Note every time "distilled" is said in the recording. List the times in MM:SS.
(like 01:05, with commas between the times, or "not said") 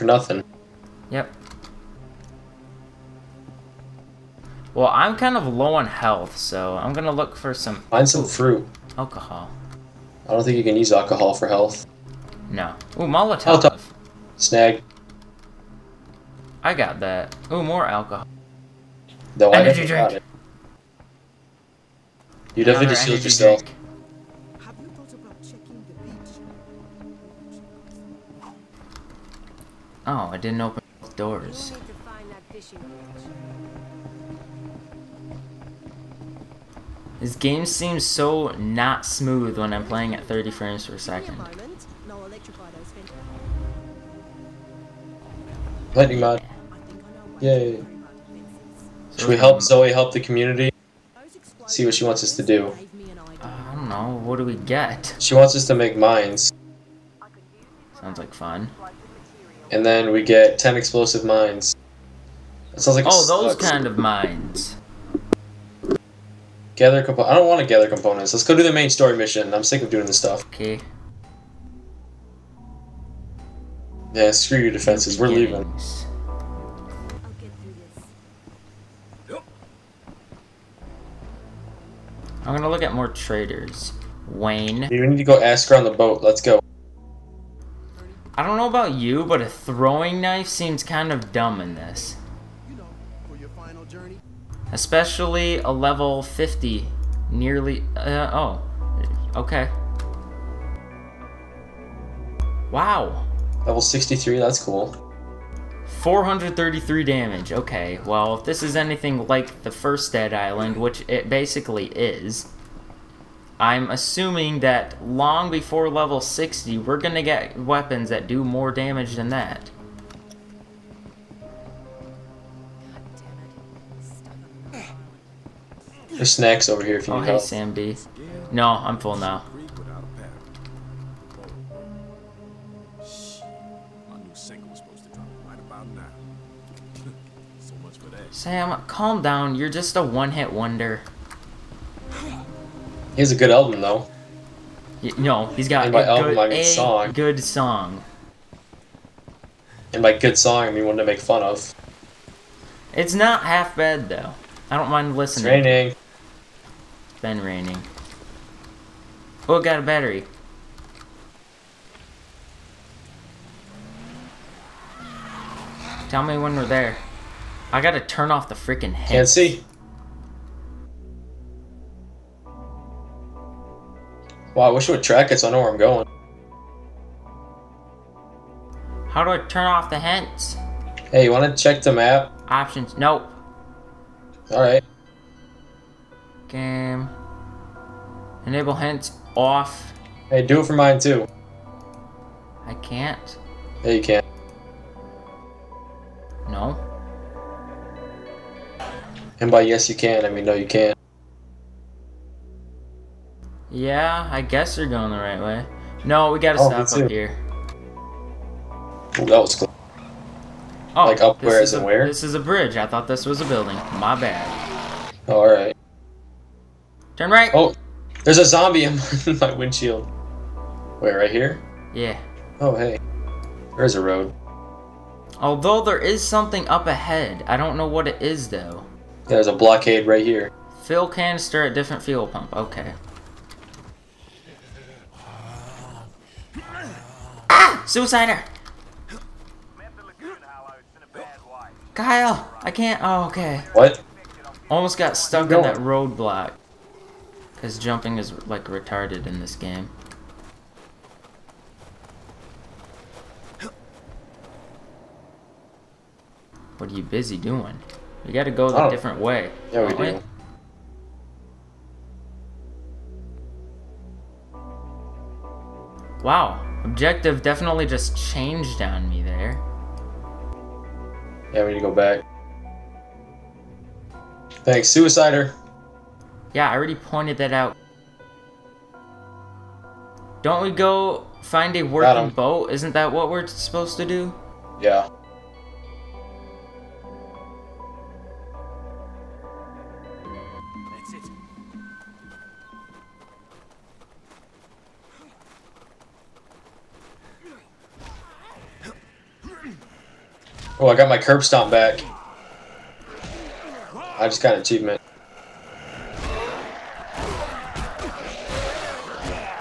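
00:22.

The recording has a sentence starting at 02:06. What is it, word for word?
There's snacks over here if you oh, need hey, help.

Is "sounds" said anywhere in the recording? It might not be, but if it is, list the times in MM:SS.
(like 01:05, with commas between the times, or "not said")
00:57, 01:02.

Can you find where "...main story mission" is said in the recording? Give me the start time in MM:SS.
01:08.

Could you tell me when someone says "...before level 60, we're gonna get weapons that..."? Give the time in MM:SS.
01:55.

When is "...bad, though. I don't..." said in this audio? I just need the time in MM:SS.
02:33.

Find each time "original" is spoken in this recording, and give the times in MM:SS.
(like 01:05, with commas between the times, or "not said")
not said.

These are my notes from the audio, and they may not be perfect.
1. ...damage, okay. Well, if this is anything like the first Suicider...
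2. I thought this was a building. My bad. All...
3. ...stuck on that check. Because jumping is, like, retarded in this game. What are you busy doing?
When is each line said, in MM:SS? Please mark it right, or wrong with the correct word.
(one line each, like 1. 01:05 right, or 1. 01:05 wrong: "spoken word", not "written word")
1. 01:47 wrong: "Dead", not "Suicider"
2. 03:32 right
3. 04:05 wrong: "roadblock", not "check".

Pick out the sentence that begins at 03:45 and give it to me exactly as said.
Although there is something up ahead.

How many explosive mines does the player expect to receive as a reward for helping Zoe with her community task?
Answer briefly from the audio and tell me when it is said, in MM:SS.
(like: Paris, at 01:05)
10, at 01:00.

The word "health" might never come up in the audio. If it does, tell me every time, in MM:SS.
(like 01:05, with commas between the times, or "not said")
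00:05, 00:11.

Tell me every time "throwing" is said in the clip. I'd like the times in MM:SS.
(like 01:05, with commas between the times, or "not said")
01:29.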